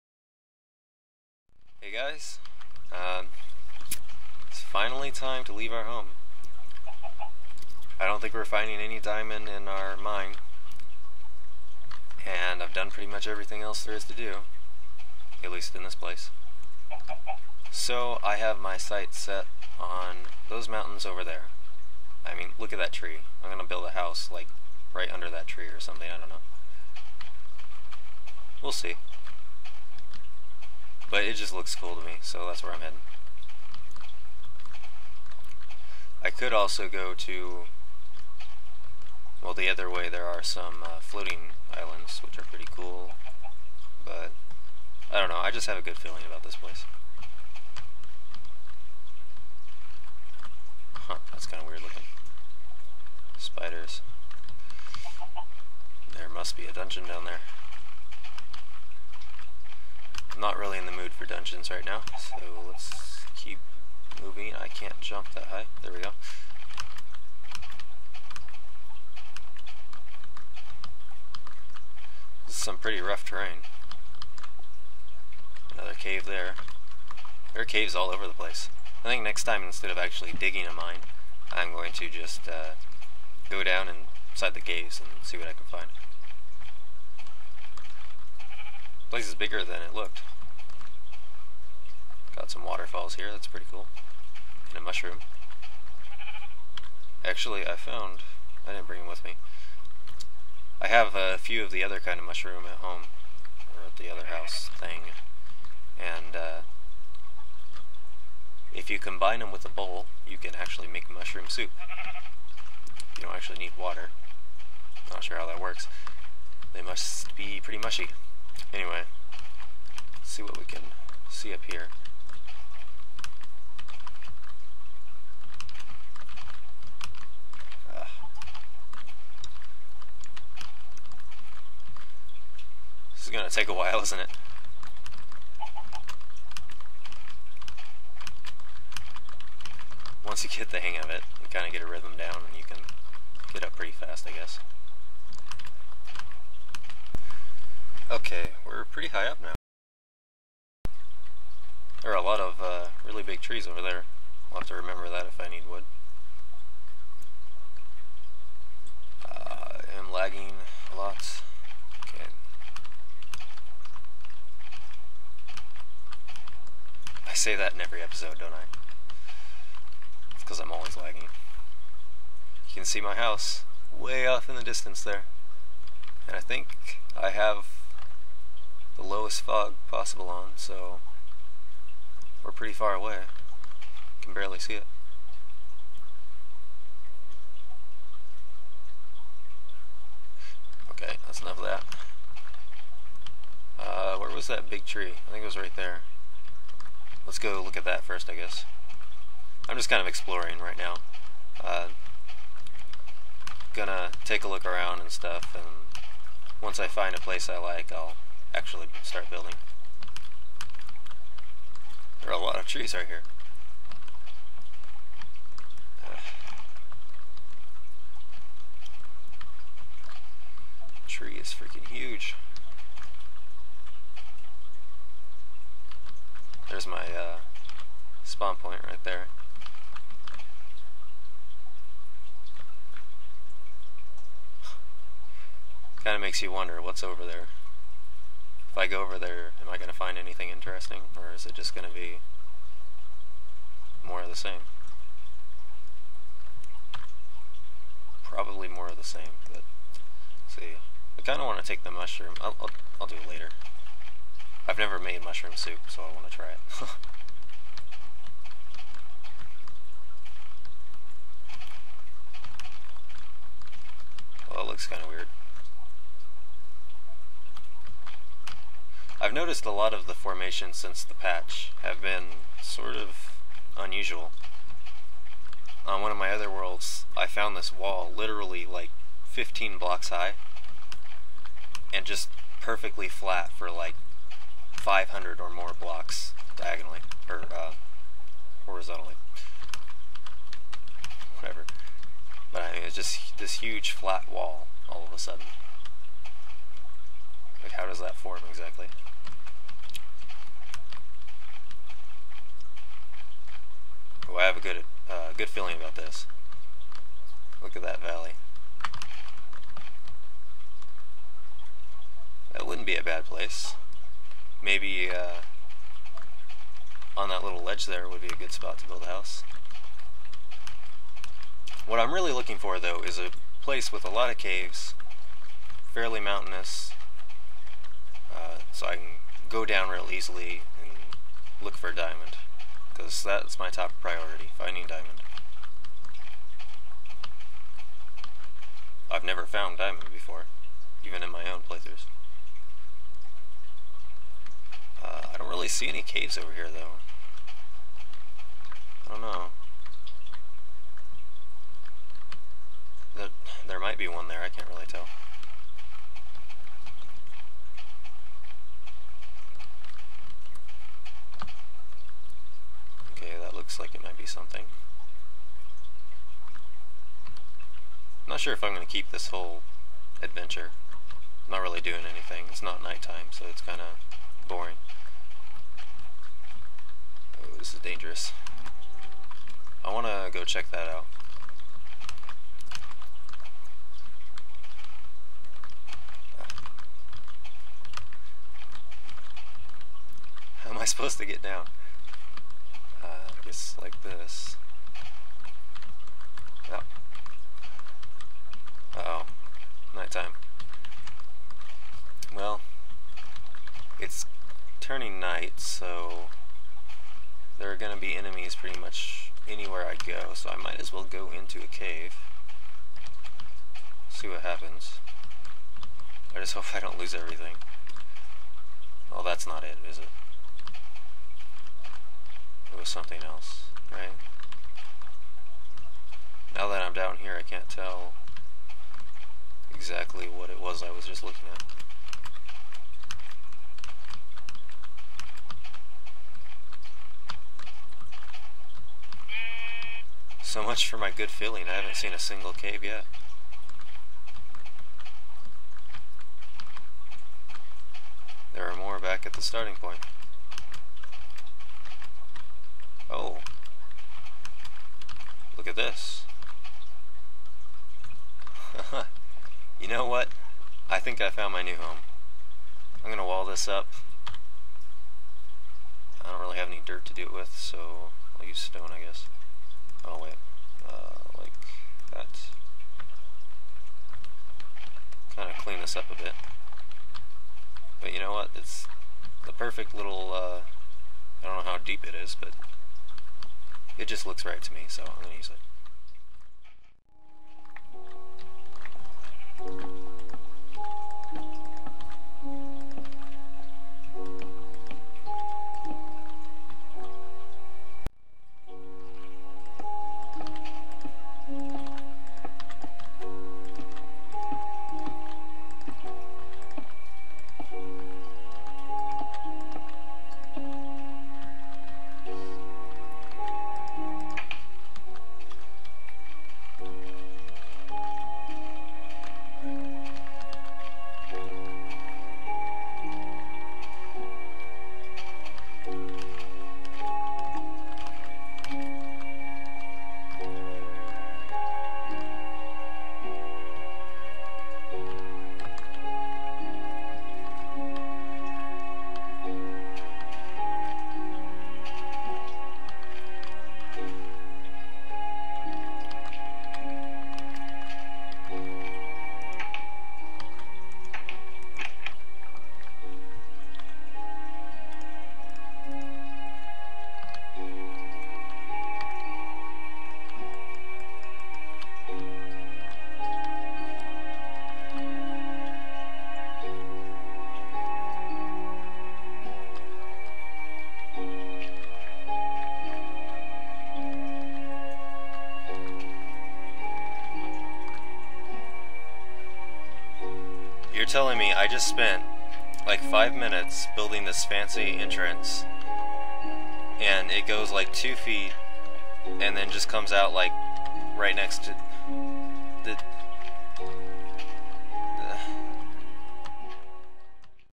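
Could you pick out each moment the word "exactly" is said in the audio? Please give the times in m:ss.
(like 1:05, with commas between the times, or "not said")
4:58, 7:09.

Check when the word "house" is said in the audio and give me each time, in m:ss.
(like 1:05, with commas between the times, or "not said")
0:23, 1:44, 2:53, 5:19.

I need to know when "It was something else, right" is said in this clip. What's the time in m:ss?
7:02.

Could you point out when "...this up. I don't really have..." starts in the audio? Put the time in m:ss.
7:43.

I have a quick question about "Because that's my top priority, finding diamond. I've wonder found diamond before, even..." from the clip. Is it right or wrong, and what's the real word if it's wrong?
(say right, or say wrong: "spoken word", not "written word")
wrong: "never", not "wonder".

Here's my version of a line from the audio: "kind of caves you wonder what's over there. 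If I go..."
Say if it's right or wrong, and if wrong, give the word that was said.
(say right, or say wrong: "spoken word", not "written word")
wrong: "makes", not "caves".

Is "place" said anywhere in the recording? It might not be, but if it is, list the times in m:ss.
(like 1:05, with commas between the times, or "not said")
0:15, 0:46, 1:18, 1:29, 3:27, 5:13, 5:23.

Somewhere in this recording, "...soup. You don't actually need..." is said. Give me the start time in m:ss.
1:51.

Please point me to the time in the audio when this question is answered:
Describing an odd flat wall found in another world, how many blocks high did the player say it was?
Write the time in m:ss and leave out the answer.
4:39.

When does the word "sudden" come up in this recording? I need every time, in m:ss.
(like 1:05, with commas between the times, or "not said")
4:55.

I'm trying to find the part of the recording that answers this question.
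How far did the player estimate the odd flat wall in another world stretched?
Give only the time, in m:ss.
4:44.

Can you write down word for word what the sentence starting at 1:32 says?
Got some waterfalls here, that's pretty cool.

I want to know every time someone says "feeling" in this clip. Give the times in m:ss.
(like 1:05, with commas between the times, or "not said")
0:45, 5:05, 7:21.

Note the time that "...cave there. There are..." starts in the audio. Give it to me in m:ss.
1:15.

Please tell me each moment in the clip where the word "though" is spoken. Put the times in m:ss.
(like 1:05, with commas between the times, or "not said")
5:22, 5:46.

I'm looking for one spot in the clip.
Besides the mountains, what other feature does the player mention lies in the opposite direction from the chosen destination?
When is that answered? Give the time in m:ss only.
0:41.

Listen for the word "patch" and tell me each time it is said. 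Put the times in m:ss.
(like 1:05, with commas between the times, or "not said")
4:31.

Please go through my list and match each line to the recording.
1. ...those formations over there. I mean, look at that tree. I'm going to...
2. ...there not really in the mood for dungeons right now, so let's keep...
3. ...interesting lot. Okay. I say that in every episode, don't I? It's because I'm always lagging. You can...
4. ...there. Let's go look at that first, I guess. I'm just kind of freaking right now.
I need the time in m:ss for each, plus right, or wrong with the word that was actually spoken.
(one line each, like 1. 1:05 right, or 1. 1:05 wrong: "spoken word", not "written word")
1. 0:20 wrong: "mountains", not "formations"
2. 0:57 right
3. 2:40 wrong: "lagging", not "interesting"
4. 3:15 wrong: "exploring", not "freaking".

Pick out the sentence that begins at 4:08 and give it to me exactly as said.
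Probably more of the same, but see.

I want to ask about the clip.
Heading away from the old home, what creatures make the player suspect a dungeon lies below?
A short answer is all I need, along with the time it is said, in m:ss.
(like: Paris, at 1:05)
Spiders, at 0:53.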